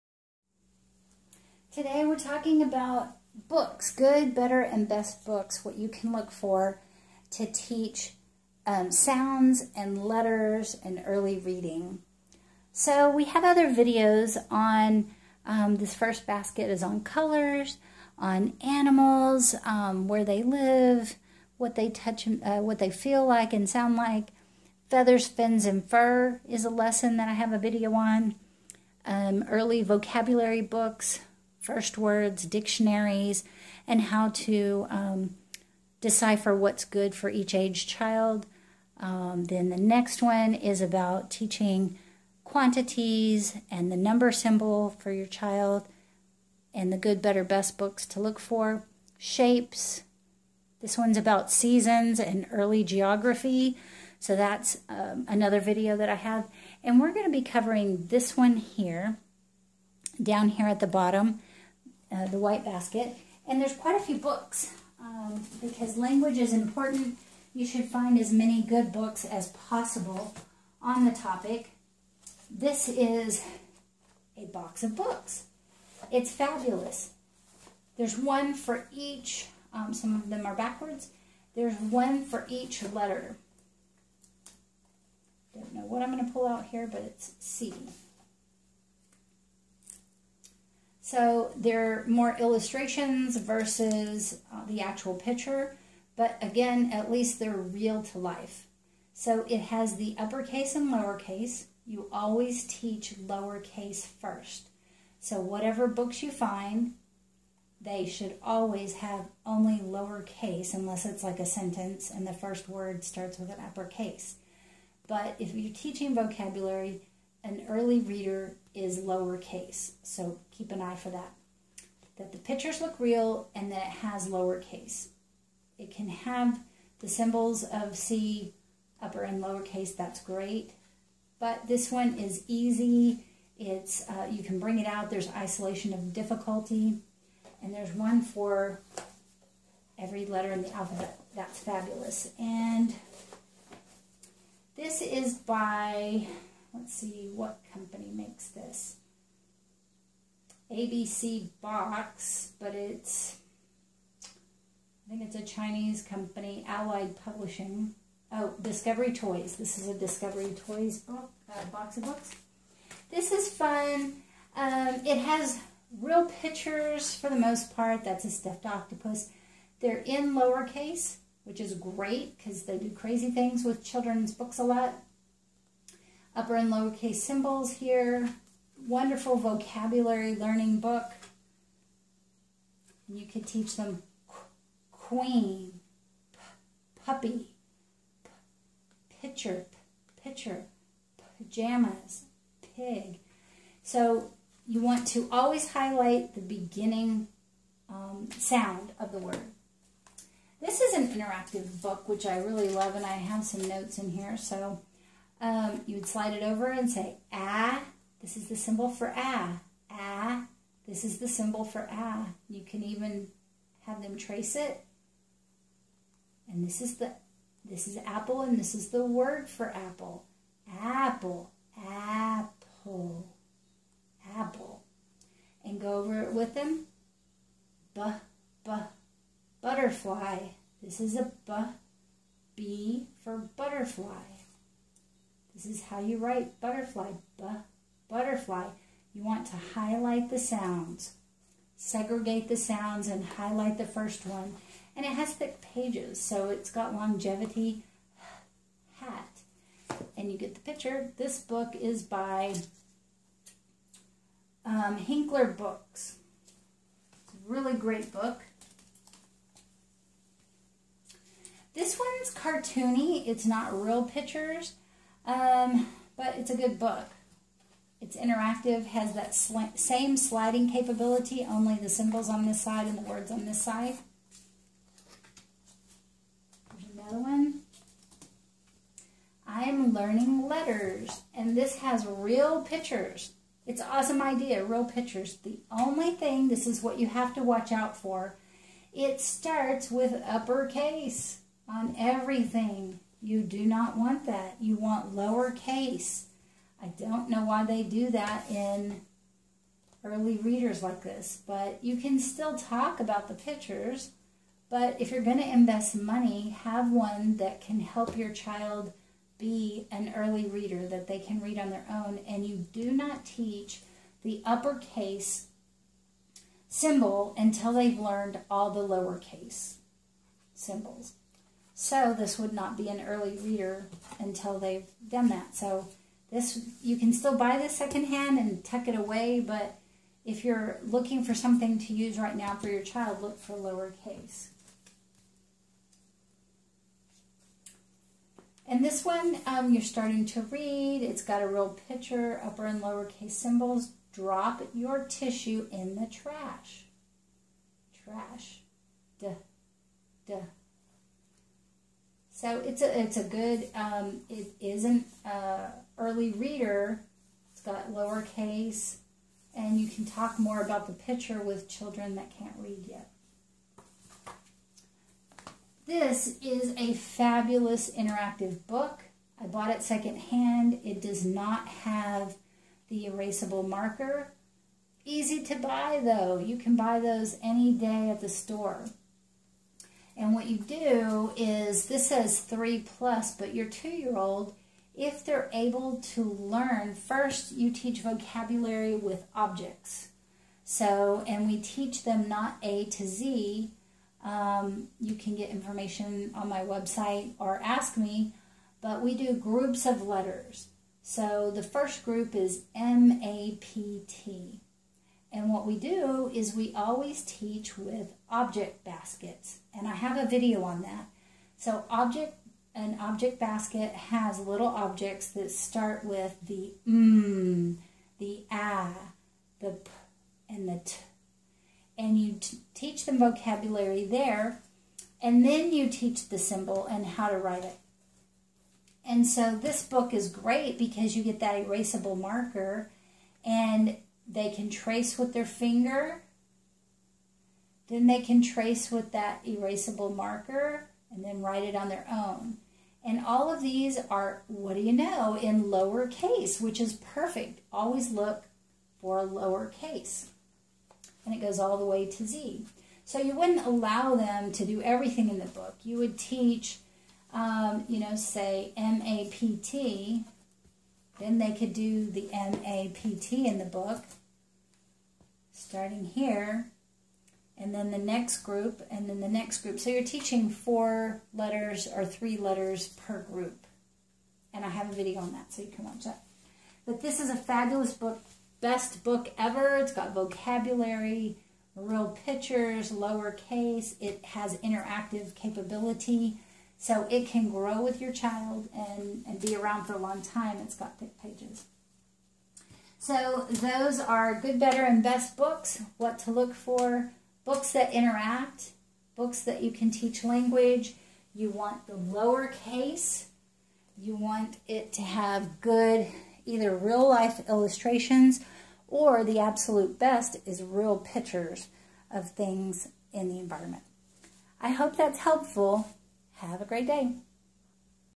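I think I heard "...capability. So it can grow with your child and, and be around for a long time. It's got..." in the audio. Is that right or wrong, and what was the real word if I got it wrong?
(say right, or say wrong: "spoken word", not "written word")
right.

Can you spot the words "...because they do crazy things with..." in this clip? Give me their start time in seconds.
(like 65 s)
172 s.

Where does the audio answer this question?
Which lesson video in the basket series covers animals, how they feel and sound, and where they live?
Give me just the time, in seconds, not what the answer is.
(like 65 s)
24 s.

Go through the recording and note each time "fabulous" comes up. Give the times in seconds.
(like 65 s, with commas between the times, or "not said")
76 s, 141 s, 366 s, 477 s.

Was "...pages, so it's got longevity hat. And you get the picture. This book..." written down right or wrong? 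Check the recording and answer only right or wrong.
right.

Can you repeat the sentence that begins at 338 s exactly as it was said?
And this one, um, you're starting to read.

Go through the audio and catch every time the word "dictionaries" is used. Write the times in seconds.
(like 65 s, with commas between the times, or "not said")
32 s.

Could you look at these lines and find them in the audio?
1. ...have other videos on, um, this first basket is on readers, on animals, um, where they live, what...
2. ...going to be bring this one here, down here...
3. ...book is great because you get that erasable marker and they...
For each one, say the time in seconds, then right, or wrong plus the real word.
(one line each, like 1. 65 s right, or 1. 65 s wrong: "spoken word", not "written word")
1. 13 s wrong: "colors", not "readers"
2. 57 s wrong: "covering", not "bring"
3. 429 s right.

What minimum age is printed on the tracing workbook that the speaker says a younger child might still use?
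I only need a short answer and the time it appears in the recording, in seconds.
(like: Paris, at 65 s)
3 plus, at 382 s.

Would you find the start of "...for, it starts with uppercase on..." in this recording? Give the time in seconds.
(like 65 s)
287 s.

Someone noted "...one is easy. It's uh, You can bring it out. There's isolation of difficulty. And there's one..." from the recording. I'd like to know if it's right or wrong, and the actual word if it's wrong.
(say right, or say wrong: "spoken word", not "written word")
right.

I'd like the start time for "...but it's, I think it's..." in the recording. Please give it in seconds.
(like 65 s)
152 s.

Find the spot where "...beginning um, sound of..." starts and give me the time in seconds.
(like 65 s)
196 s.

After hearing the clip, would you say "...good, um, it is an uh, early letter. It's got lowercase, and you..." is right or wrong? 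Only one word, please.
wrong.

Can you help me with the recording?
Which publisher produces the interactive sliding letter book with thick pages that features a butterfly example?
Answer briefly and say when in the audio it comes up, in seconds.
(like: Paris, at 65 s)
Hinkler Books, at 254 s.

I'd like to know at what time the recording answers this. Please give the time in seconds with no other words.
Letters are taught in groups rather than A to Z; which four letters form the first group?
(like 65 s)
402 s.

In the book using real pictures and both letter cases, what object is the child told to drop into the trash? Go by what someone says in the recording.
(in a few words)
tissue.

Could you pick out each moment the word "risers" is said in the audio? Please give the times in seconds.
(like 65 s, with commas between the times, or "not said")
not said.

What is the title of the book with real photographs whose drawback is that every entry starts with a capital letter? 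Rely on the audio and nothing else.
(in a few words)
I am learning letters.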